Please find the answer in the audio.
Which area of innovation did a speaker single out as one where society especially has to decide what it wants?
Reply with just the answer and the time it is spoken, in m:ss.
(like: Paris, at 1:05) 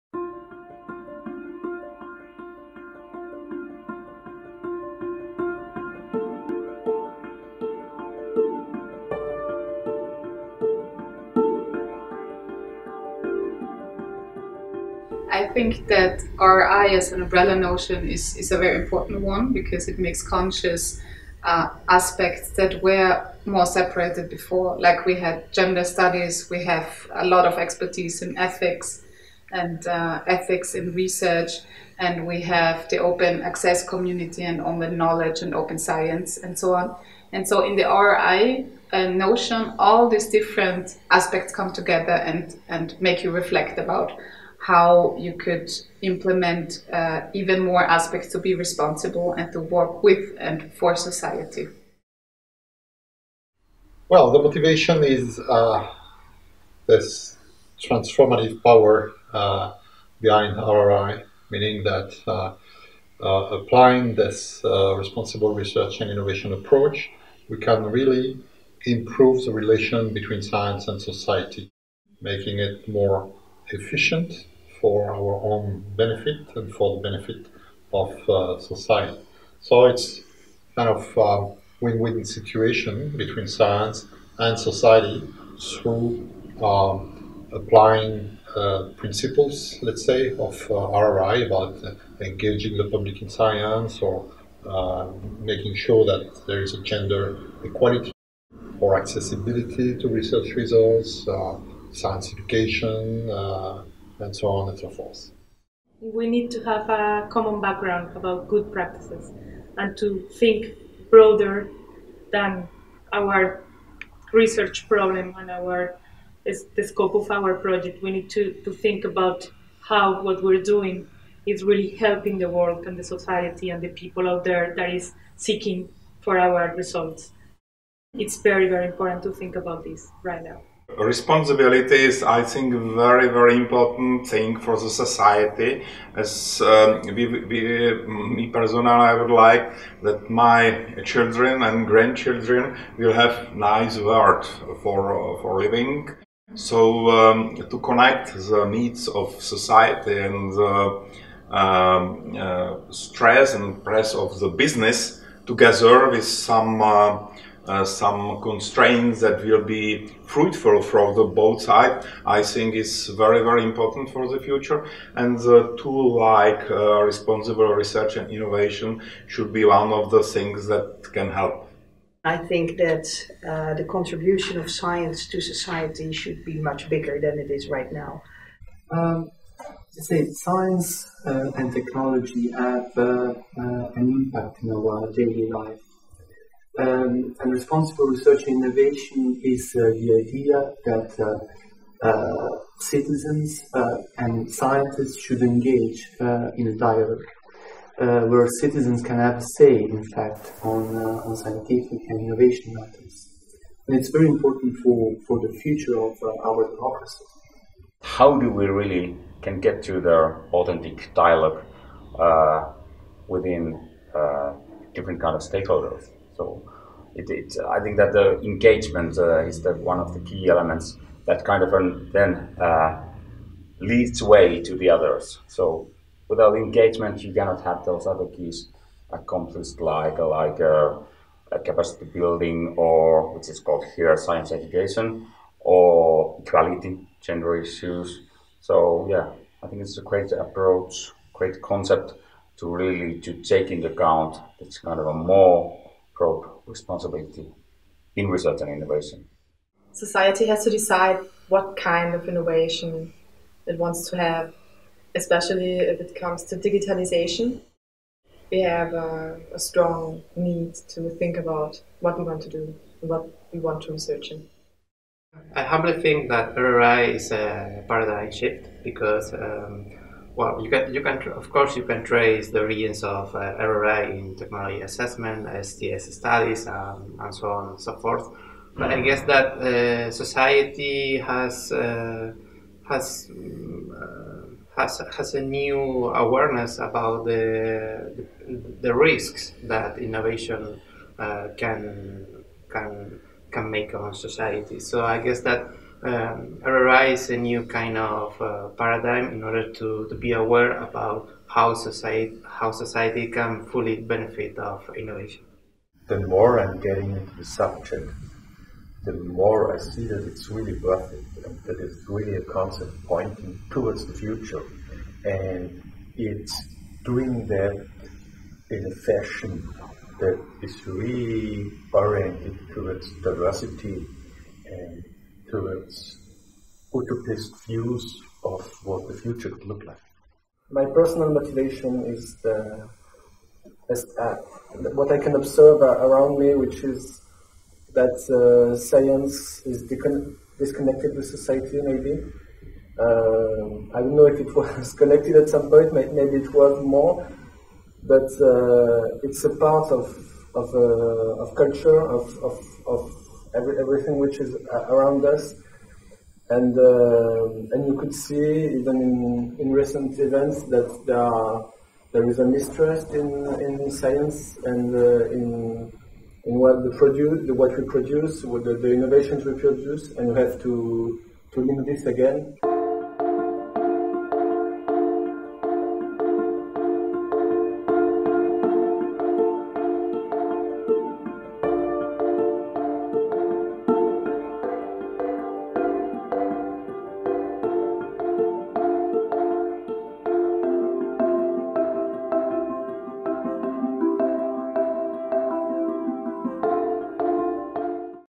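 digitalization, at 4:16.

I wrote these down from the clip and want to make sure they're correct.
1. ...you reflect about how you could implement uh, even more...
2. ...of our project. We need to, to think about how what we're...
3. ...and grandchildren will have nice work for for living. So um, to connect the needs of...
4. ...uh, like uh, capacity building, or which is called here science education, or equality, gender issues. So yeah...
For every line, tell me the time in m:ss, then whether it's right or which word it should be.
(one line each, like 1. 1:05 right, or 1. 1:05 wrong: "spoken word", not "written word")
1. 0:43 right
2. 1:57 right
3. 2:21 right
4. 3:50 right.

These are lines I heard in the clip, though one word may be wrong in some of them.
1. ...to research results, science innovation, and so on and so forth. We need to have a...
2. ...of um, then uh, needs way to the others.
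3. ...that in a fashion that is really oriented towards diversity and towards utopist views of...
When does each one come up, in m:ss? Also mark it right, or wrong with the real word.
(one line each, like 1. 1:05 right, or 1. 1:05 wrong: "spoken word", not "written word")
1. 1:39 wrong: "education", not "innovation"
2. 3:41 wrong: "leads", not "needs"
3. 5:17 right.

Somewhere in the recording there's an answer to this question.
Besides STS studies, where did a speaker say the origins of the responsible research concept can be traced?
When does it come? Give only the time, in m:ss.
4:34.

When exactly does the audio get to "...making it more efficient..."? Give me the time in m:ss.
1:12.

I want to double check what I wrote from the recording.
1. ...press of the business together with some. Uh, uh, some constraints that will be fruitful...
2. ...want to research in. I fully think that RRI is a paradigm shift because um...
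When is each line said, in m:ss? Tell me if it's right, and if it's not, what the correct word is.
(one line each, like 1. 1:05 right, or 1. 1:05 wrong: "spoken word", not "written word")
1. 2:33 right
2. 4:23 wrong: "humbly", not "fully".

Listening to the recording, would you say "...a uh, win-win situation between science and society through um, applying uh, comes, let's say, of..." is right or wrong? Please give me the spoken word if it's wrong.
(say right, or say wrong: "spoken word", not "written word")
wrong: "principles", not "comes".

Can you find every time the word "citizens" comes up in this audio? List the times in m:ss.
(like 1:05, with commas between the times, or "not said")
3:12, 3:18.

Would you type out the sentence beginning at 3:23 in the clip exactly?
And it's very important for, for the future of our democracy.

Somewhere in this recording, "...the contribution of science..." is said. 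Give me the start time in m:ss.
2:53.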